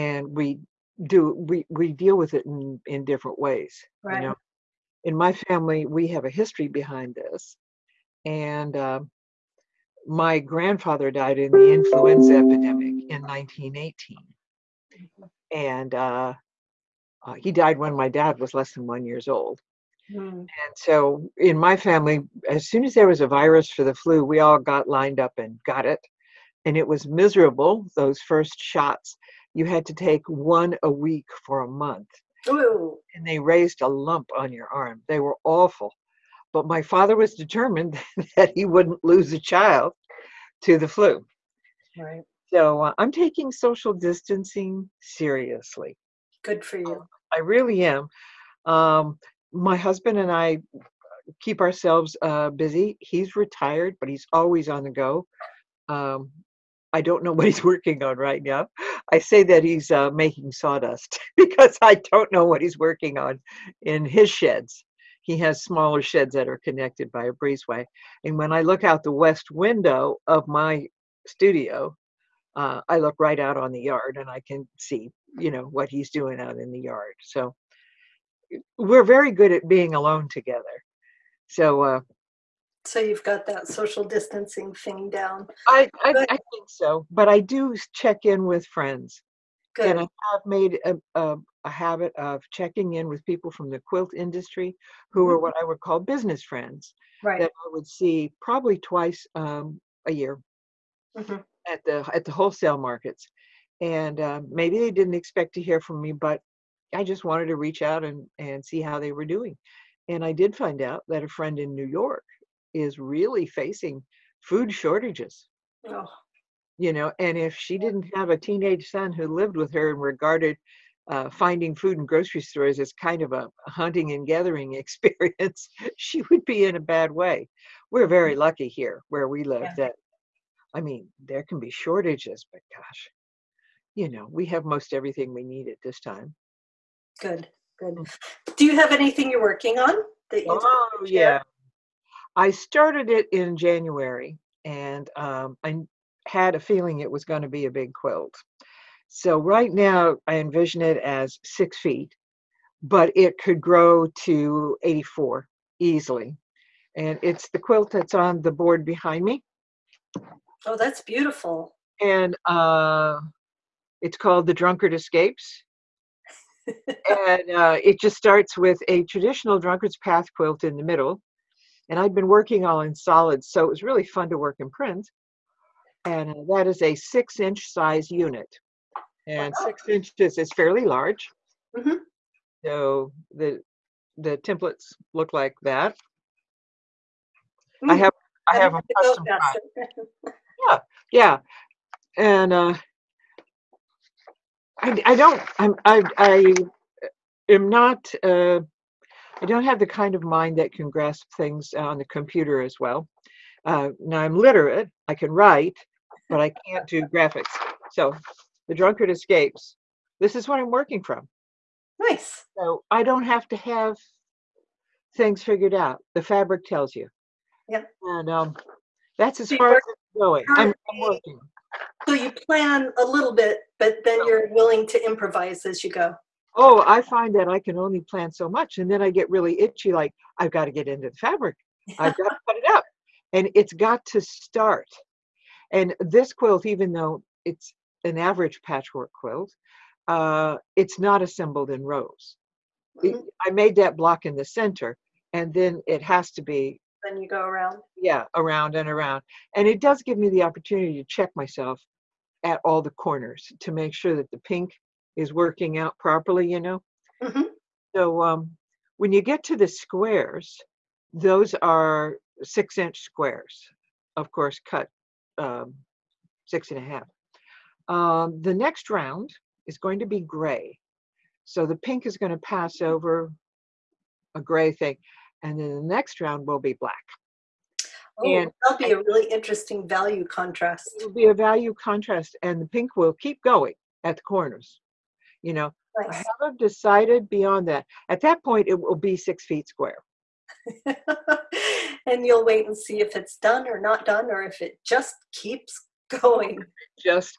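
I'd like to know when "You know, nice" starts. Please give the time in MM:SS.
04:45.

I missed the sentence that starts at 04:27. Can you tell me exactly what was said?
Um, the next round is going to be gray.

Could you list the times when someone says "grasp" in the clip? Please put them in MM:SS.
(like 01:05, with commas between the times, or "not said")
03:20.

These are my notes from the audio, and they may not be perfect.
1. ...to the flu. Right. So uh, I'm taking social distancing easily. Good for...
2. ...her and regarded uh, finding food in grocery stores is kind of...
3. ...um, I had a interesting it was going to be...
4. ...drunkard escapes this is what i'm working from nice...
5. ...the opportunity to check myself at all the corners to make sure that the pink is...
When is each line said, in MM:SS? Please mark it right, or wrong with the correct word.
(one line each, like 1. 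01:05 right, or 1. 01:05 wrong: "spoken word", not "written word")
1. 00:40 wrong: "seriously", not "easily"
2. 01:59 right
3. 02:25 wrong: "feeling", not "interesting"
4. 03:28 right
5. 04:10 right.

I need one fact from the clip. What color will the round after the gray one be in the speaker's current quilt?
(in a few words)
black.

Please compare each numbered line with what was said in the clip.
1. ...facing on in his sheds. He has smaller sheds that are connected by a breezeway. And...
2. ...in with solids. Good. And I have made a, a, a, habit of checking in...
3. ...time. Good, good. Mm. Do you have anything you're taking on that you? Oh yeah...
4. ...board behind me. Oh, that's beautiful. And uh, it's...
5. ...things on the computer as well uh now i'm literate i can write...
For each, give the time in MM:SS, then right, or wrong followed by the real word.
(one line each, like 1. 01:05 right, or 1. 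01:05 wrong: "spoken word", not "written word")
1. 01:02 wrong: "working", not "facing"
2. 01:28 wrong: "friends", not "solids"
3. 02:15 wrong: "working", not "taking"
4. 02:38 right
5. 03:21 right.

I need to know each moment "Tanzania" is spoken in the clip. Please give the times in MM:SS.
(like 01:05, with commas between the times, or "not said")
not said.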